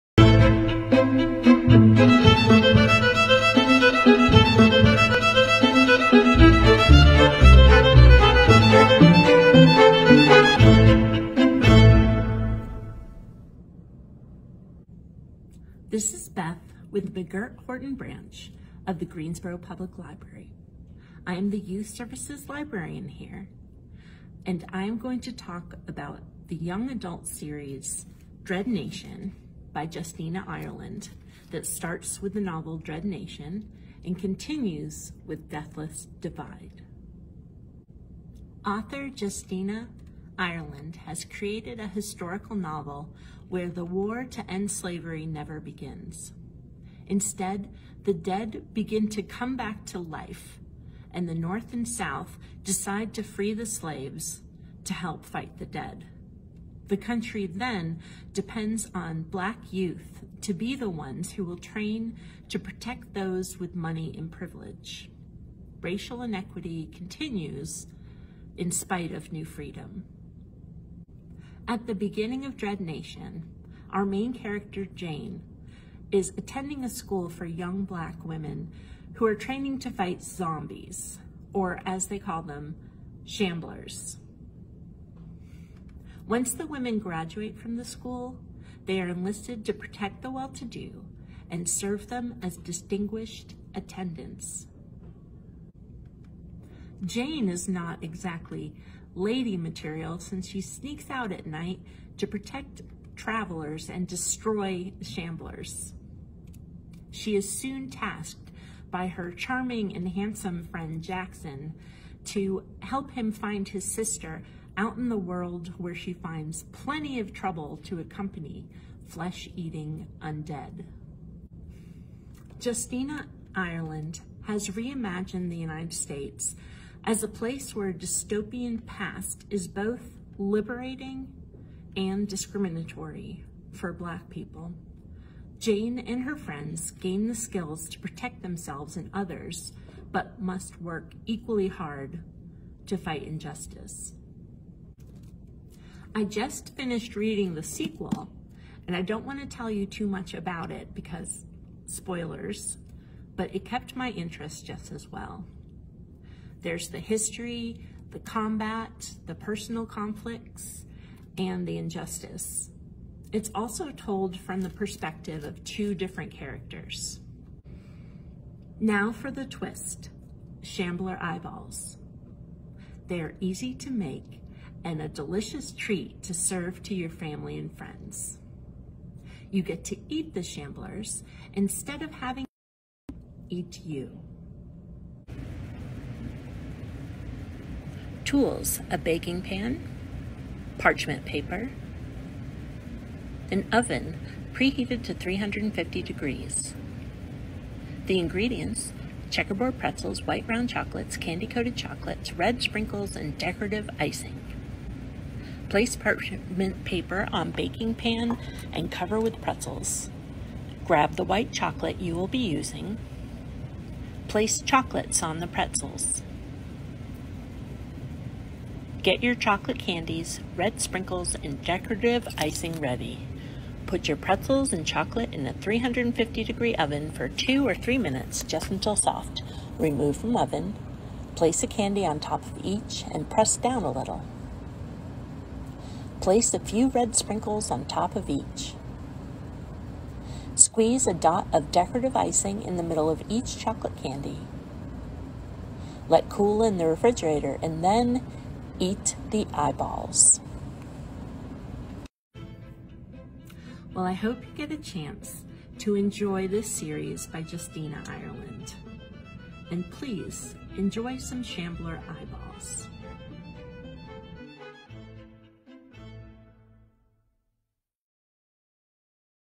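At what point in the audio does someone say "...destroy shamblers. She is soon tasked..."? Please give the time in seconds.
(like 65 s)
104 s.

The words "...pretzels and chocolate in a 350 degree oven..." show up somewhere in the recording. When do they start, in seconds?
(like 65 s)
224 s.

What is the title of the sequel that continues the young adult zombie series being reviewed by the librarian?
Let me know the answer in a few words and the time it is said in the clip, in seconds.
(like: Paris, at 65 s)
Deathless Divide, at 35 s.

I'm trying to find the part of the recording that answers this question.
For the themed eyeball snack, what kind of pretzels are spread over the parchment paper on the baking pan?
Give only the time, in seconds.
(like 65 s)
199 s.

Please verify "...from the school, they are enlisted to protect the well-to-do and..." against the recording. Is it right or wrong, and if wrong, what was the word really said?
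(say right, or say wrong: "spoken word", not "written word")
right.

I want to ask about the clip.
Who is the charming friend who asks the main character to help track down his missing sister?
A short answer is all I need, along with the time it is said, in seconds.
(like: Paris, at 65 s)
Jackson, at 111 s.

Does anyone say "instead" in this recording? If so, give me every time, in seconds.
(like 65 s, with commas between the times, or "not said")
47 s, 181 s.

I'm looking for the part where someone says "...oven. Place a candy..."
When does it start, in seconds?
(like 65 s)
230 s.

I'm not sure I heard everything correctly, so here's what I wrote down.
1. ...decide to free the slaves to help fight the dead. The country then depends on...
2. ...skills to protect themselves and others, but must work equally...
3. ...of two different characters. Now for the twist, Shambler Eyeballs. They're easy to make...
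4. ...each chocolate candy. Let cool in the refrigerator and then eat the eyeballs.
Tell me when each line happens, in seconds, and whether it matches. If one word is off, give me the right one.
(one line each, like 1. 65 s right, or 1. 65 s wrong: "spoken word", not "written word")
1. 52 s right
2. 137 s right
3. 165 s right
4. 243 s right.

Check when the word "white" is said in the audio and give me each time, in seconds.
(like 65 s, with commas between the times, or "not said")
200 s, 211 s.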